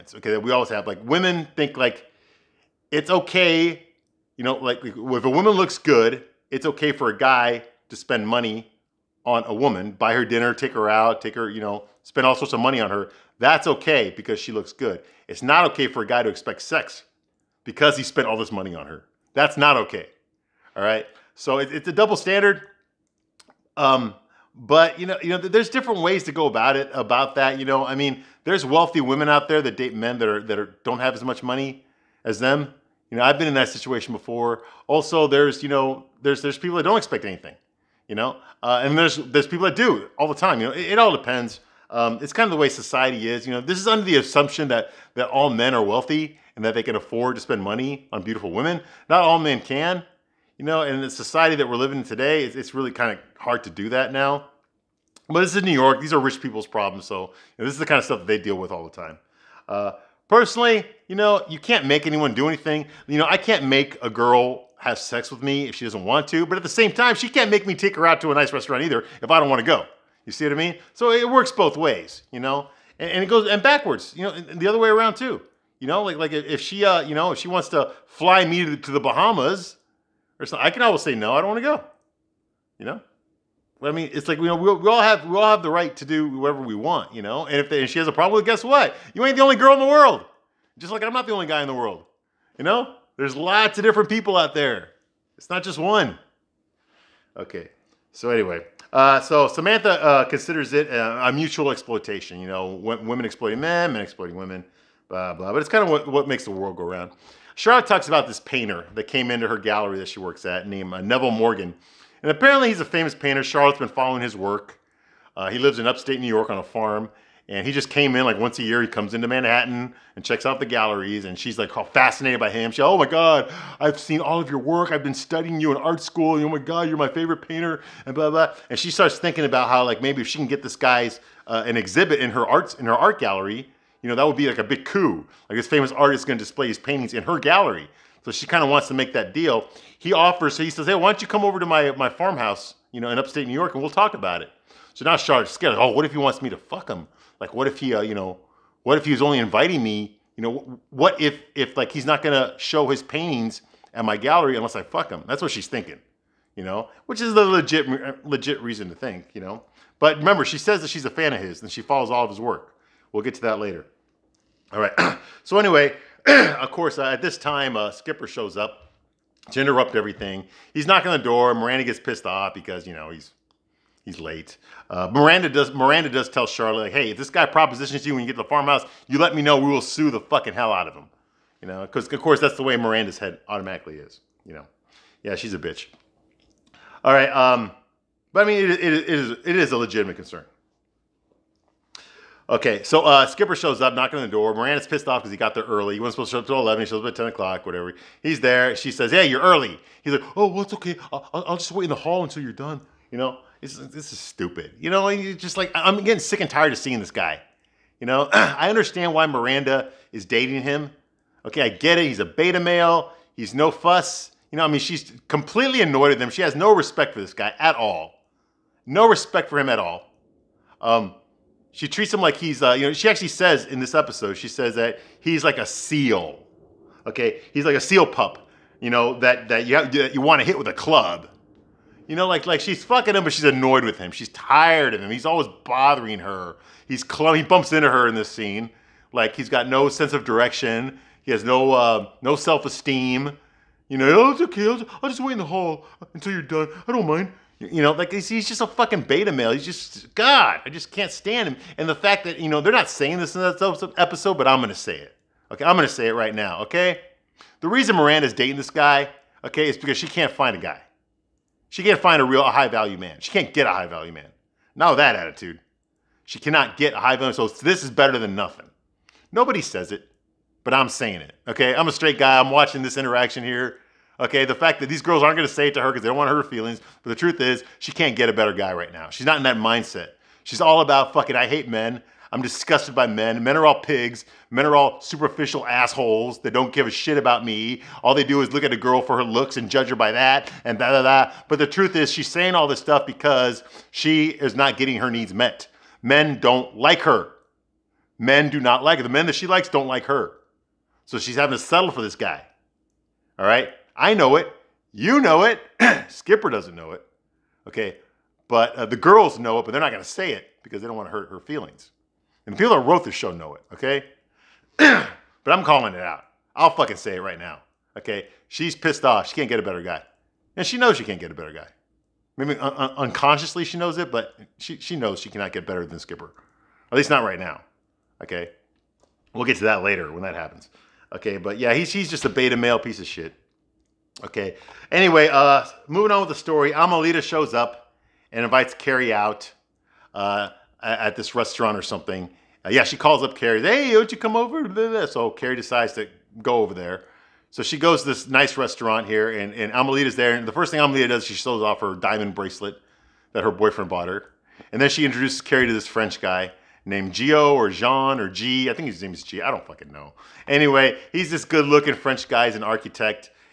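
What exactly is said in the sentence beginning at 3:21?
I'll, I'll just wait in the hall until you're done.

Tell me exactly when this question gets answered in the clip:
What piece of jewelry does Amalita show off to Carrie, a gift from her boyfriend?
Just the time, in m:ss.
5:51.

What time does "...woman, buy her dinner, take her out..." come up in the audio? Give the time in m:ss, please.
0:09.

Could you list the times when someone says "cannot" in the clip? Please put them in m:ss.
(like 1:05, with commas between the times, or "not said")
4:26, 5:25.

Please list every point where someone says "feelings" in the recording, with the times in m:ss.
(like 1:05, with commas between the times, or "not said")
4:36, 5:11.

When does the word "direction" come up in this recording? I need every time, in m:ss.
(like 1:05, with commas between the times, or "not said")
4:00.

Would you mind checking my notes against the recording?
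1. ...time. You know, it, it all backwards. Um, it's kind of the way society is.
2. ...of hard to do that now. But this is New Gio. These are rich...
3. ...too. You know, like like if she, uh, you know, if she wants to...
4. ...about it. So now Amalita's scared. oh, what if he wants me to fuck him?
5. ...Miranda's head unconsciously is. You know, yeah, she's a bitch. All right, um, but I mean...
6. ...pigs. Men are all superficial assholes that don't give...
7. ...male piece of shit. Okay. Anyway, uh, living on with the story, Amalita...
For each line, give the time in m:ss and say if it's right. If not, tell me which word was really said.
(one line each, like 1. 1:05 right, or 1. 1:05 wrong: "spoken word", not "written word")
1. 0:40 wrong: "depends", not "backwards"
2. 0:53 wrong: "York", not "Gio"
3. 1:15 right
4. 2:24 wrong: "Charlotte", not "Amalita"
5. 3:02 wrong: "automatically", not "unconsciously"
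6. 4:43 right
7. 5:32 wrong: "moving", not "living".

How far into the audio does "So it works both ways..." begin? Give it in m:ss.
1:10.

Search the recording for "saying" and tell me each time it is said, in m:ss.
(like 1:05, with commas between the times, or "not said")
4:12, 4:30, 4:52.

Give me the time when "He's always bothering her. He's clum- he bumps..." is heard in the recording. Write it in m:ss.
3:55.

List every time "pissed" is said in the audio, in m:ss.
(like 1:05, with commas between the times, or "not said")
2:51, 3:14, 5:18.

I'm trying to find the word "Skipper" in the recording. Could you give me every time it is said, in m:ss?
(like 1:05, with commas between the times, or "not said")
2:47, 3:13, 5:06, 5:25.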